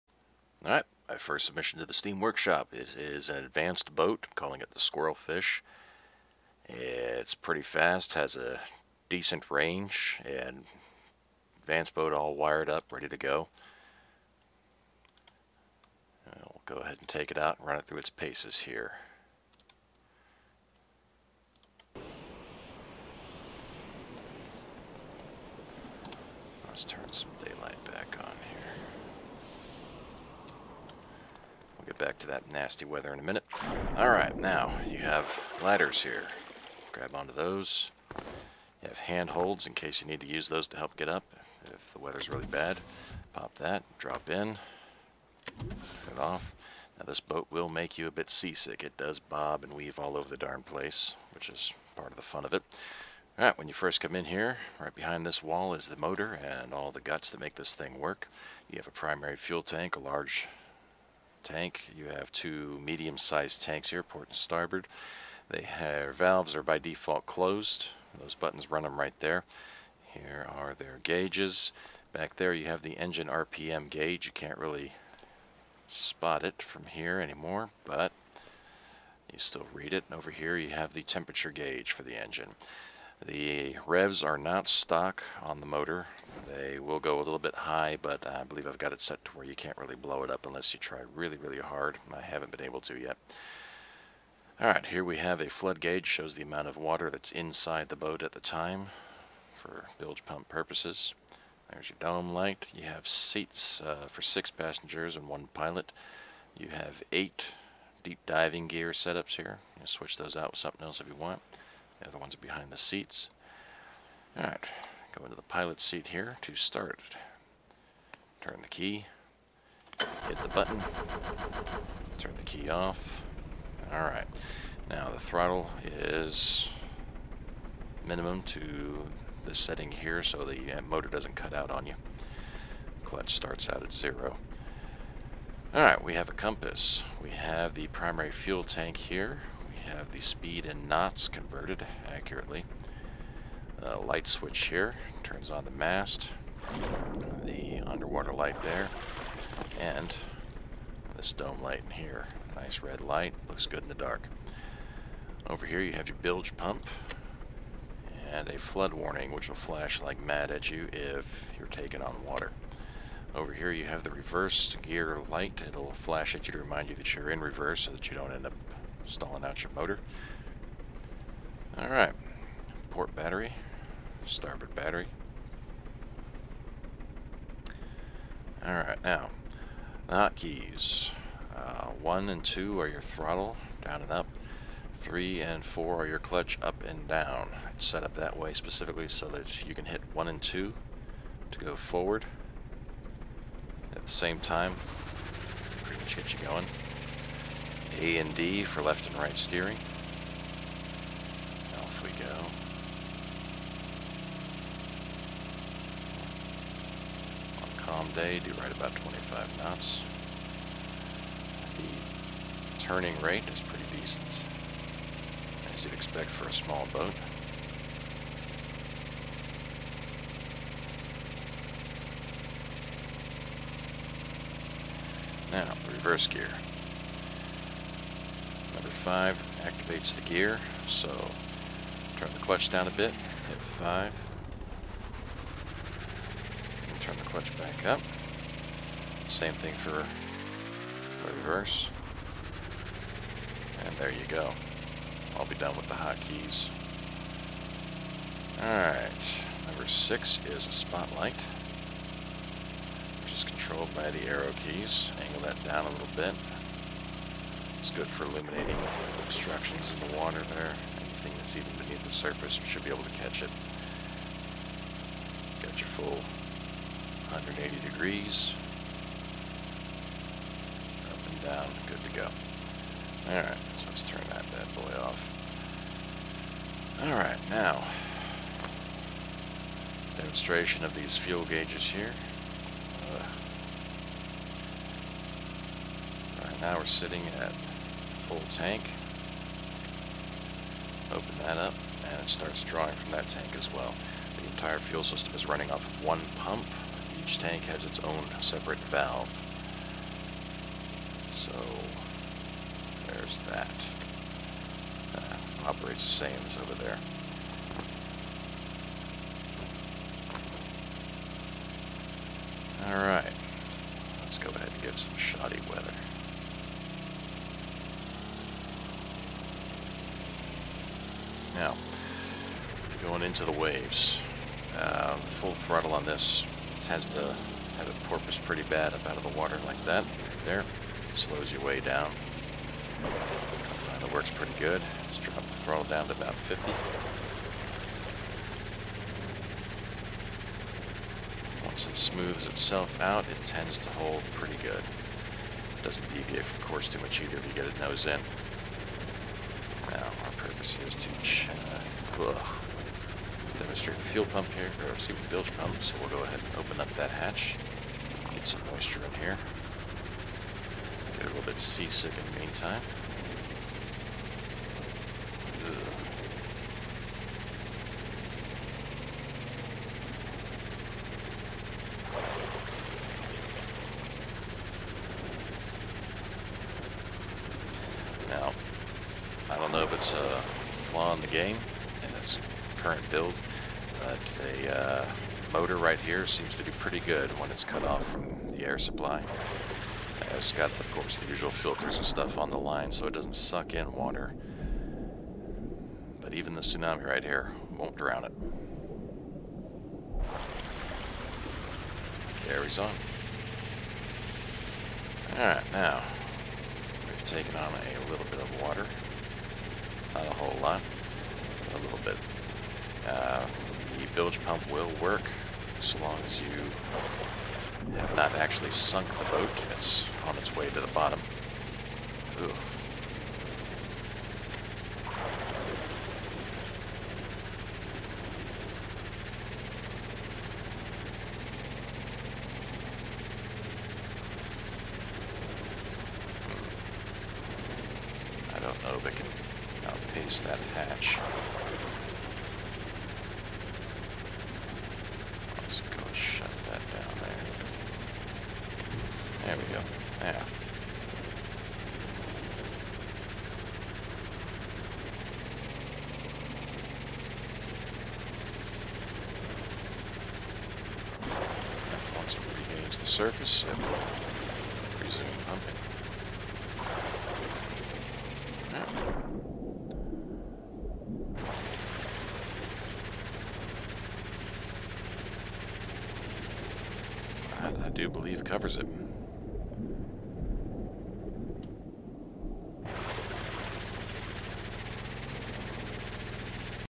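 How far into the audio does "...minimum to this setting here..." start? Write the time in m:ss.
2:08.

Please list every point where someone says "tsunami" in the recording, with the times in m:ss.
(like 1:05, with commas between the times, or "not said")
6:36.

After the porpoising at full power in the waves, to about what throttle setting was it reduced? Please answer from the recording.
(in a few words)
50.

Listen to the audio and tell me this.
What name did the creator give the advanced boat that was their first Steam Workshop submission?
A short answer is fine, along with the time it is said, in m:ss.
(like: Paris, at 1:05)
Squirrelfish, at 0:04.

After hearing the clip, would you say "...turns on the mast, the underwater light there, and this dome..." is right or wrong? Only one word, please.
right.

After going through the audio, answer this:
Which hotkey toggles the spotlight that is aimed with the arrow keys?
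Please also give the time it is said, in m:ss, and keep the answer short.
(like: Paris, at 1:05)
6, at 4:09.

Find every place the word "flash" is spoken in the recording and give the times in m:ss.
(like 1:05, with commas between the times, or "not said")
2:39, 2:45.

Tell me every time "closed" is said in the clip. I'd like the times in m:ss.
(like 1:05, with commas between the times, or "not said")
1:07.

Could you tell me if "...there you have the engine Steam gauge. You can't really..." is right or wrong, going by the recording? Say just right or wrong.
wrong.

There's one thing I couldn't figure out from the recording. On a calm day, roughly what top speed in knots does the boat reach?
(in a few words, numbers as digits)
25 knots.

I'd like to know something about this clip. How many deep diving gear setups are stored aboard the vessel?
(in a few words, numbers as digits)
8.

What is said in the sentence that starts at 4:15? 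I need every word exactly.
Angle that down a little bit.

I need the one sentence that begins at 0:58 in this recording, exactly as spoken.
You have a primary fuel tank, a large tank.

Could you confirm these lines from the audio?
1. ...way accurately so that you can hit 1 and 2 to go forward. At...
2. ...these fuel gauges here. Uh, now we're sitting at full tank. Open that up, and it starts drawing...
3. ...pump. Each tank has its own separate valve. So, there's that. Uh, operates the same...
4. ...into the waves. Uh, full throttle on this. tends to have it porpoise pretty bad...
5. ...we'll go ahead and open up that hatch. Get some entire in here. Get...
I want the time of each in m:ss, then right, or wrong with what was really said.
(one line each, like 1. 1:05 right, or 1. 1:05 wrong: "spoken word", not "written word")
1. 3:08 wrong: "specifically", not "accurately"
2. 4:40 right
3. 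4:56 right
4. 5:23 right
5. 5:56 wrong: "moisture", not "entire".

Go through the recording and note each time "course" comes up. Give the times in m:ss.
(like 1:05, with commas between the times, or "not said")
5:46, 6:30.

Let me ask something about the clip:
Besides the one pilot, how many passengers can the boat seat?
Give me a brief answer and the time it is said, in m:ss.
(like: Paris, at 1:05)
6, at 1:44.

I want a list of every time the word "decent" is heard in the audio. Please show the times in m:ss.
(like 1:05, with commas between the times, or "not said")
0:09, 3:33.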